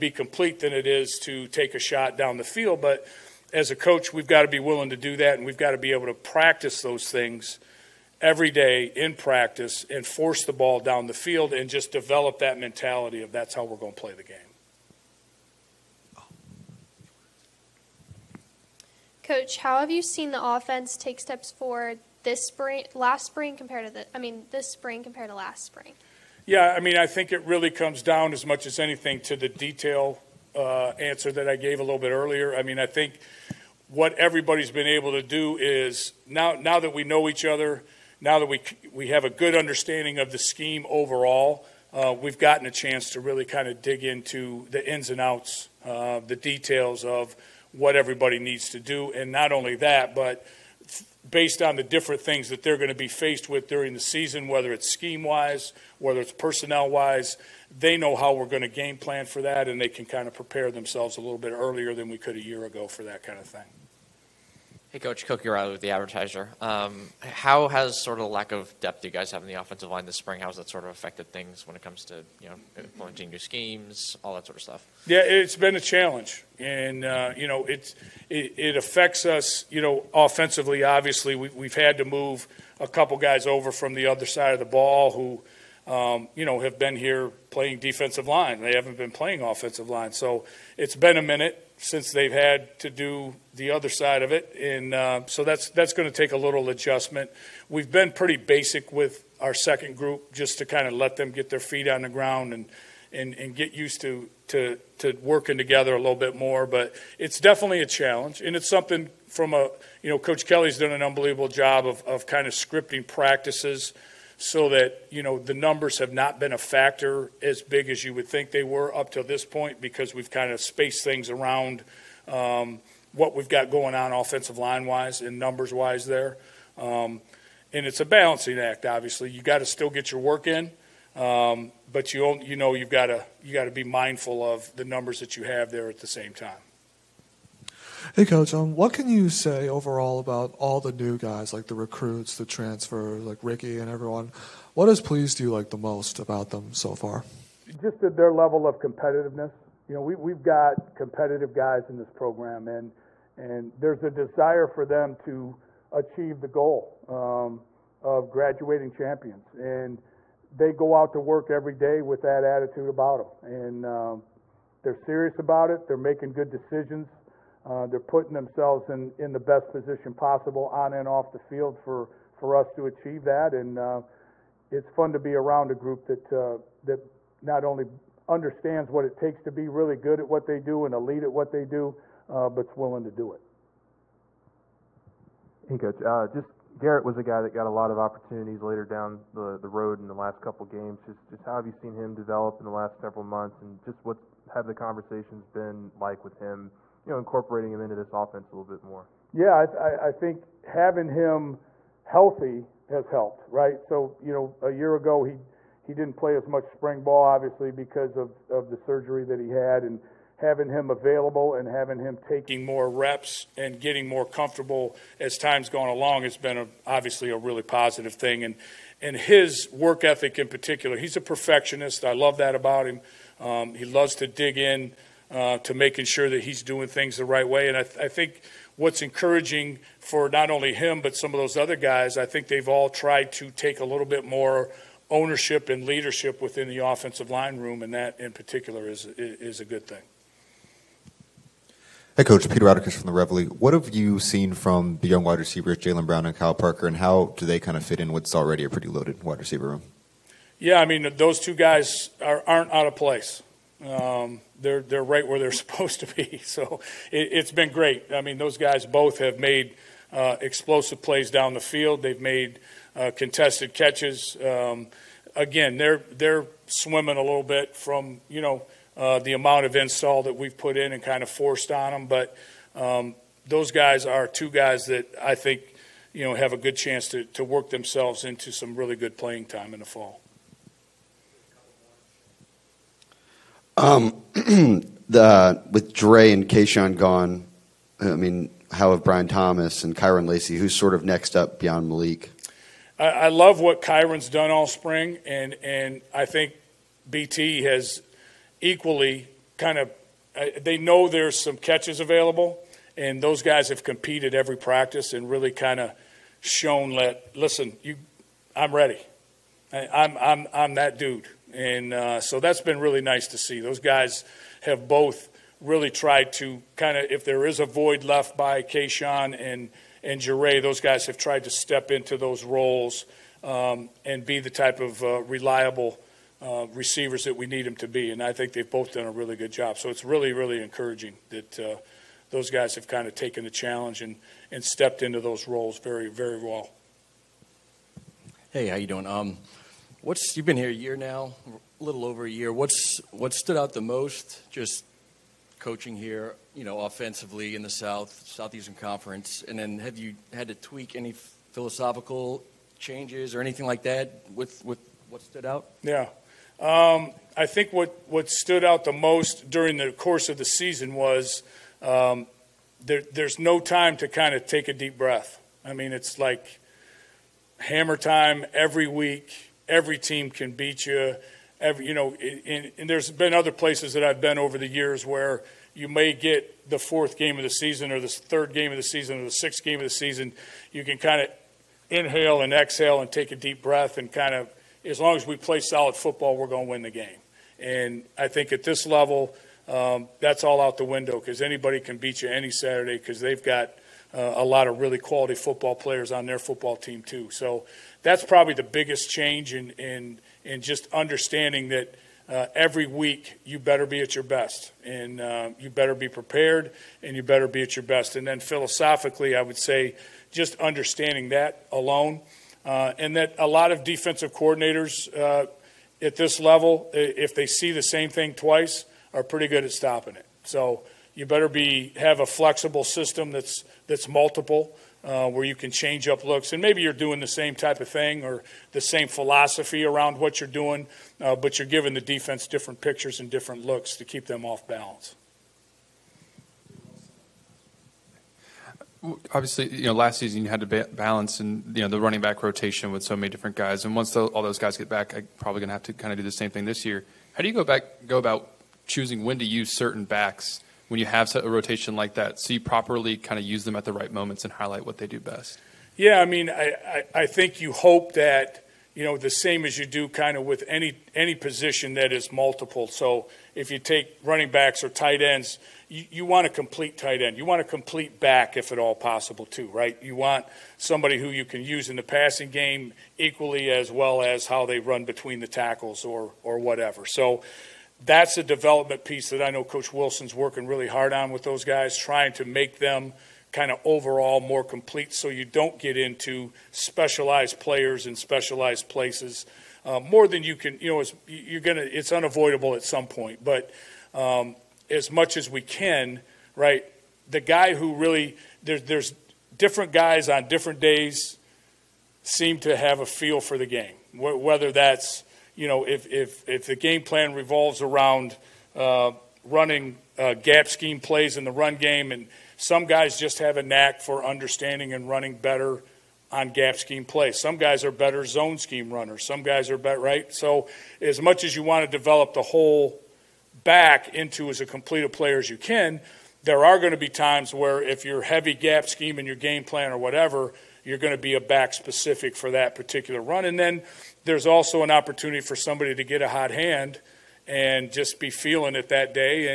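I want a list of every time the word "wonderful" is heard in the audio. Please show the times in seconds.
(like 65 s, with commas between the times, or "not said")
not said.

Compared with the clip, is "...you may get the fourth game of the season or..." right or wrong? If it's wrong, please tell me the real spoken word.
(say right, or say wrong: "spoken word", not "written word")
right.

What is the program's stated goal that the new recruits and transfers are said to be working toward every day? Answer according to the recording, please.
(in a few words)
graduating champions.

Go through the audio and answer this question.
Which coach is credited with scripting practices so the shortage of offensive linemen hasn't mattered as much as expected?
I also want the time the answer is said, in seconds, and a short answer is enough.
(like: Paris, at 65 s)
Coach Kelly, at 110 s.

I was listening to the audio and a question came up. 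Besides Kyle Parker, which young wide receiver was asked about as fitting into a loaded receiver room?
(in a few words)
Jalen Brown.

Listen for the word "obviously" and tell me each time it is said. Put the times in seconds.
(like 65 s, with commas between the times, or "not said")
80 s, 128 s, 207 s, 216 s, 439 s.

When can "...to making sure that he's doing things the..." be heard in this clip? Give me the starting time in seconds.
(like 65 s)
225 s.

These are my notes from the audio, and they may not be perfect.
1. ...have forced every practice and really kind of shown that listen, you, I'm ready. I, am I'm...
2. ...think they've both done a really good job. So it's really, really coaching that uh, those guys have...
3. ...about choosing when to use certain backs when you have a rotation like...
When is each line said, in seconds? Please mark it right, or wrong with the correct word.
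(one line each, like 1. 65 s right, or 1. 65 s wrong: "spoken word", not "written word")
1. 303 s wrong: "competed", not "forced"
2. 328 s wrong: "encouraging", not "coaching"
3. 448 s right.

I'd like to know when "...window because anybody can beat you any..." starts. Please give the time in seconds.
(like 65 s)
390 s.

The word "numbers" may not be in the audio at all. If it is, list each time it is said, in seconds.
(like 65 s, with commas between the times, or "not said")
115 s, 125 s, 134 s.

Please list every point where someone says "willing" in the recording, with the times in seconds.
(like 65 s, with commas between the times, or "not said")
4 s, 182 s.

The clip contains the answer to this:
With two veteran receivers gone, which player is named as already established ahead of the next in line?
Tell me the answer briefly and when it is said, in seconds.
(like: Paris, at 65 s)
Malik, at 291 s.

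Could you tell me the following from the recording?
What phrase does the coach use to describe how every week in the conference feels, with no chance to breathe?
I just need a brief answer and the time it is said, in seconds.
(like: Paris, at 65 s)
hammer time, at 367 s.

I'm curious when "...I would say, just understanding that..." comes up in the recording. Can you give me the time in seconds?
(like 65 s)
409 s.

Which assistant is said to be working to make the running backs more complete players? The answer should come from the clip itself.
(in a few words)
Coach Wilson.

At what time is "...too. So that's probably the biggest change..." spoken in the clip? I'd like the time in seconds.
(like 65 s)
397 s.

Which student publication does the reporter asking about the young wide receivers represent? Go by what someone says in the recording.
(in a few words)
the Reveille.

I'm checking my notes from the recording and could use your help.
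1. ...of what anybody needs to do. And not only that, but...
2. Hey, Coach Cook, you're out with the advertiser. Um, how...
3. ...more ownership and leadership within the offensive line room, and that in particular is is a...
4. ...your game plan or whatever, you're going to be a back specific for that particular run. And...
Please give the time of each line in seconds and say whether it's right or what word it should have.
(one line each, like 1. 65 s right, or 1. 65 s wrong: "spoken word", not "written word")
1. 47 s wrong: "everybody", not "anybody"
2. 64 s right
3. 234 s right
4. 529 s right.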